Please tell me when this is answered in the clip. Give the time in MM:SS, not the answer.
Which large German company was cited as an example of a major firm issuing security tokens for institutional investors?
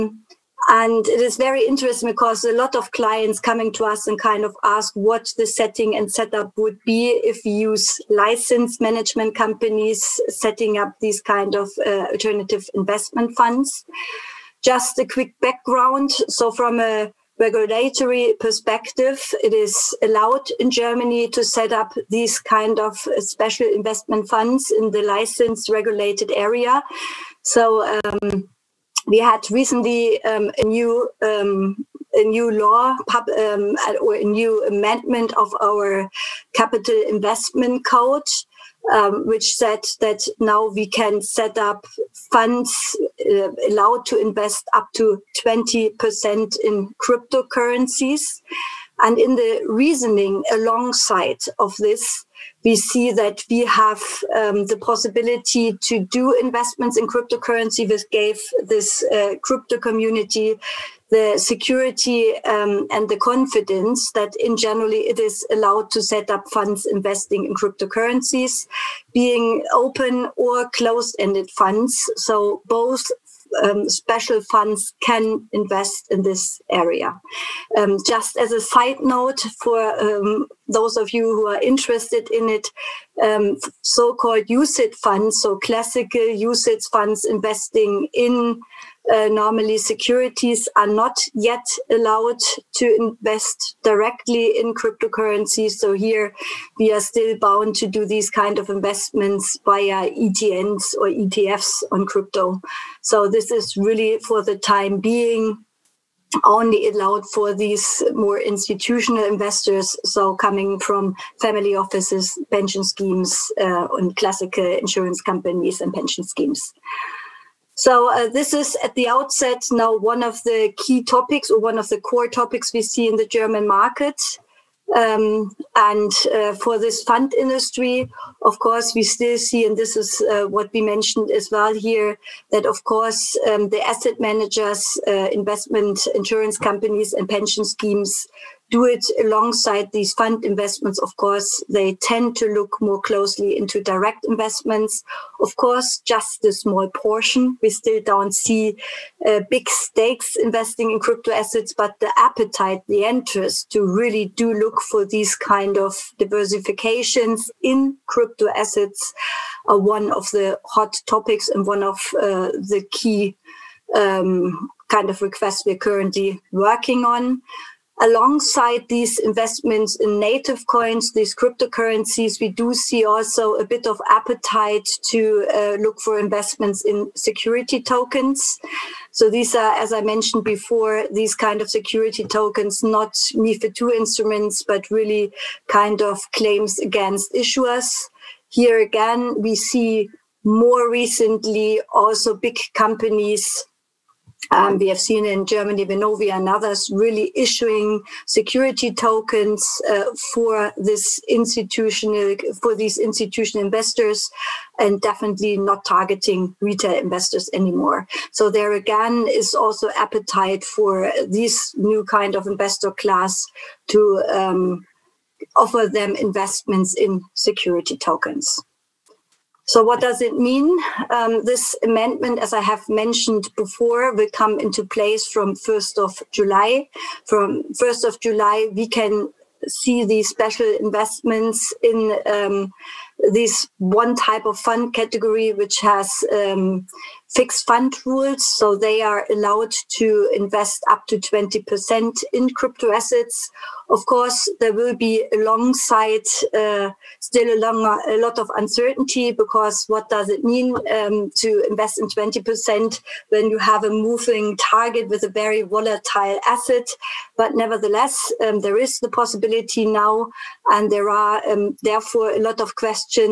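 03:15.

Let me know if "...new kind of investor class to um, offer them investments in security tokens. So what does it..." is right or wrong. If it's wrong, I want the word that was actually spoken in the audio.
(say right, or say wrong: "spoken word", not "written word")
right.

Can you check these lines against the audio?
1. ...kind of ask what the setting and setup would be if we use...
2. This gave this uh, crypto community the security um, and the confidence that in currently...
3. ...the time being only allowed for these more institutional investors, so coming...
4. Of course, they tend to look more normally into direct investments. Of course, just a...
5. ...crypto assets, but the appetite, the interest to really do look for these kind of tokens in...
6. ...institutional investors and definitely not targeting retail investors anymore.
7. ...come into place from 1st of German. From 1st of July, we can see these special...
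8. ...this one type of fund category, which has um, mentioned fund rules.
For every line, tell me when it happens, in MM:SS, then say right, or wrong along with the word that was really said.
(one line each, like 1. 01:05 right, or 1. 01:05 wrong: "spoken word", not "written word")
1. 00:04 right
2. 00:57 wrong: "generally", not "currently"
3. 01:44 right
4. 02:20 wrong: "closely", not "normally"
5. 02:30 wrong: "diversifications", not "tokens"
6. 03:22 right
7. 03:44 wrong: "July", not "German"
8. 03:53 wrong: "fixed", not "mentioned".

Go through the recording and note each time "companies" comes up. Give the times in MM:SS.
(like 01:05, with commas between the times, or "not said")
00:09, 01:55, 02:16, 03:12.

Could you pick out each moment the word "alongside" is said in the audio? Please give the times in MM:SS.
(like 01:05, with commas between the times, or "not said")
00:50, 02:19, 02:47, 04:05.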